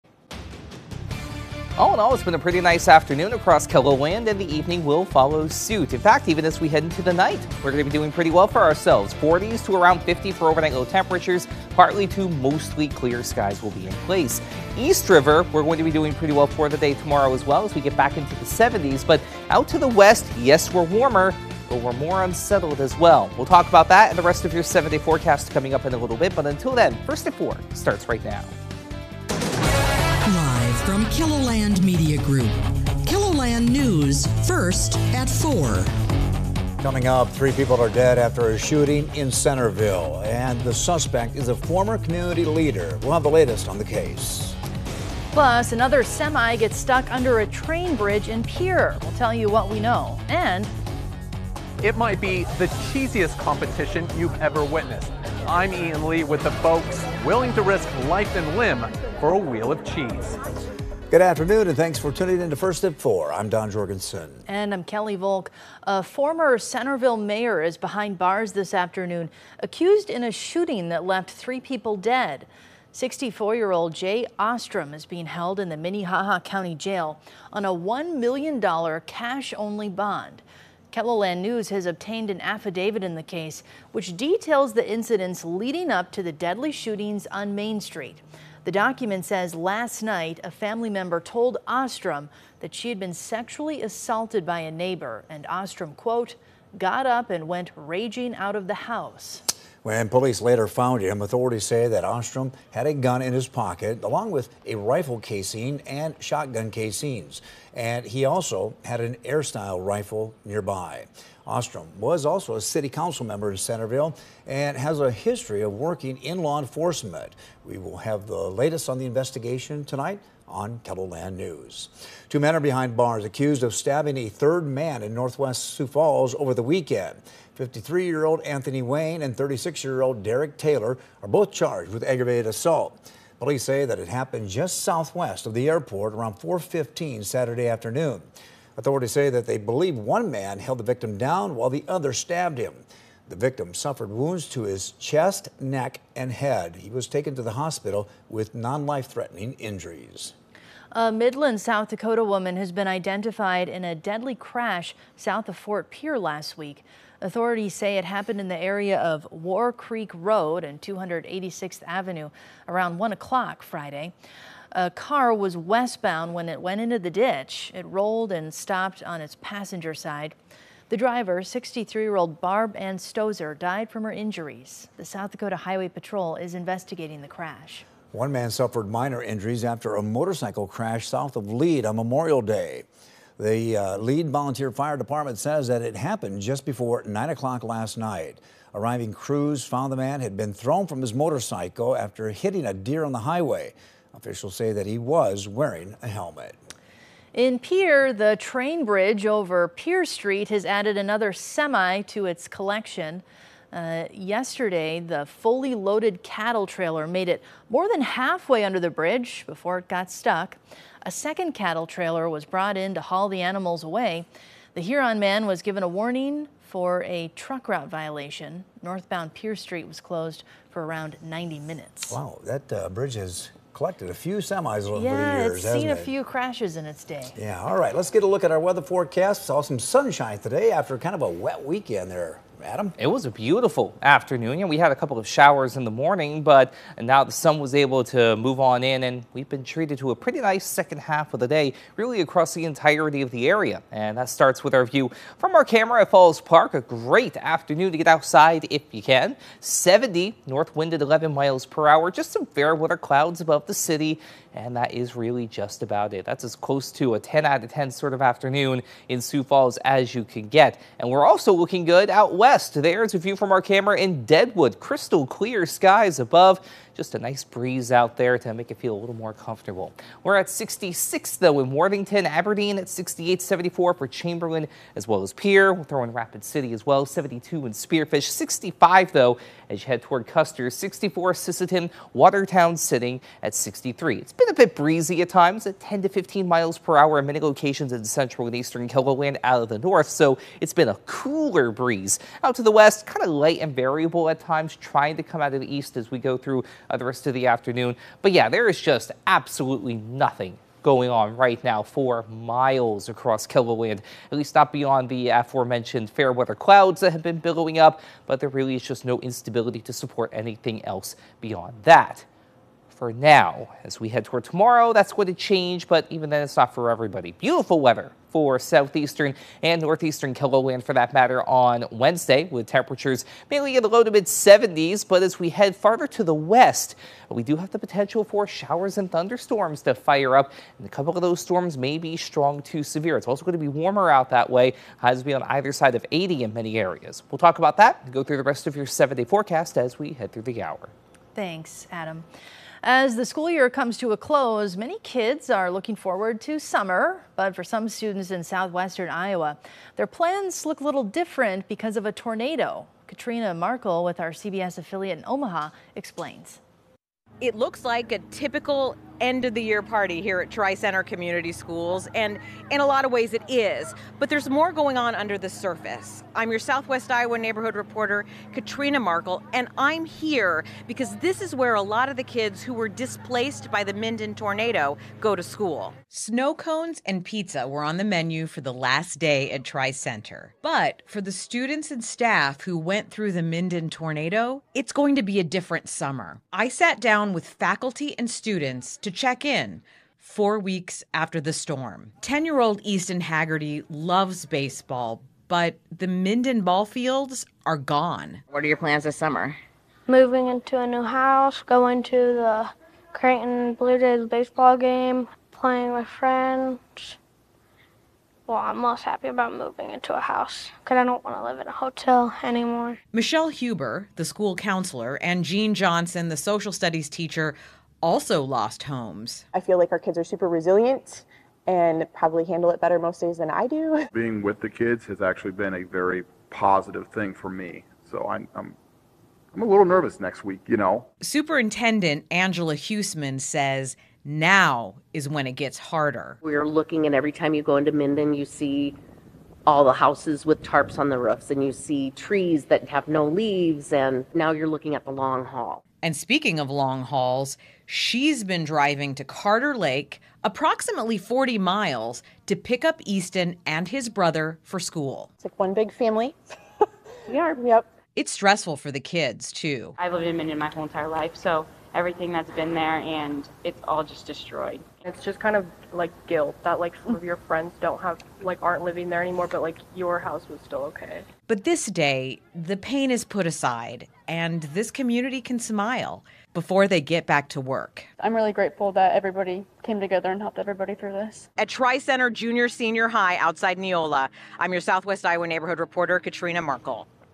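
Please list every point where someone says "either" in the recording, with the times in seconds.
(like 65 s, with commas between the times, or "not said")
335 s.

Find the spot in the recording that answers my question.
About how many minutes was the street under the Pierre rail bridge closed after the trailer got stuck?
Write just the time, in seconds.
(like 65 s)
221 s.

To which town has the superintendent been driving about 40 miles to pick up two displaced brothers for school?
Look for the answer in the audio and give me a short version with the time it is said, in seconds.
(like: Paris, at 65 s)
Carter Lake, at 449 s.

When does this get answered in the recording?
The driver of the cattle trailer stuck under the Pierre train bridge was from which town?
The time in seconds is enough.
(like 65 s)
214 s.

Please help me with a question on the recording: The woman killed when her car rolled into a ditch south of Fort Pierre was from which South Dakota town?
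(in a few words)
Midland.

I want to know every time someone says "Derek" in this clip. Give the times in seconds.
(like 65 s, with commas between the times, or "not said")
130 s.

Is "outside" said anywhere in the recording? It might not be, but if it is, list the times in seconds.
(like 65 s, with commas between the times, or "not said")
248 s, 483 s.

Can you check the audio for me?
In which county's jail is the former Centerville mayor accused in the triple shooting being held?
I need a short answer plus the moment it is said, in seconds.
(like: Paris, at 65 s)
Minnehaha County, at 75 s.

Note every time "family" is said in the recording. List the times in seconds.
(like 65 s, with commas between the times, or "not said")
90 s, 455 s.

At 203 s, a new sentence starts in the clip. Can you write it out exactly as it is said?
Uh, yesterday, the fully loaded cattle trailer made it more than halfway under the bridge before it got stuck.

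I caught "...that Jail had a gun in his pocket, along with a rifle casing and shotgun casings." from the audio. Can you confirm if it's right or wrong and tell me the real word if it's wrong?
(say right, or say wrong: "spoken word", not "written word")
wrong: "Ostrom", not "Jail".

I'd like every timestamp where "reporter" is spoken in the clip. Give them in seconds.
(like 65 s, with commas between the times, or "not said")
367 s, 485 s.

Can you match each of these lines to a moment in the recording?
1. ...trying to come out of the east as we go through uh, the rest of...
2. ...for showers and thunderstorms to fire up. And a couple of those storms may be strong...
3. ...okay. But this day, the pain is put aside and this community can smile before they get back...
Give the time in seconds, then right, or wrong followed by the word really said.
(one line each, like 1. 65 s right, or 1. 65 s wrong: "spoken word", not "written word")
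1. 294 s right
2. 328 s right
3. 470 s right.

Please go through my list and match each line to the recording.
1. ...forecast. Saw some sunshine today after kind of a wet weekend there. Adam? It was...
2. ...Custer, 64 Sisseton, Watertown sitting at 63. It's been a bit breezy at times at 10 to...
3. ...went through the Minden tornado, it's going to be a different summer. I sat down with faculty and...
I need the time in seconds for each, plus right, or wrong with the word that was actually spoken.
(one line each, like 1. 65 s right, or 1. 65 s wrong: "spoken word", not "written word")
1. 228 s right
2. 280 s right
3. 382 s right.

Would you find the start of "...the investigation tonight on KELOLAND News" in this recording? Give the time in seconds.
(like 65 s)
118 s.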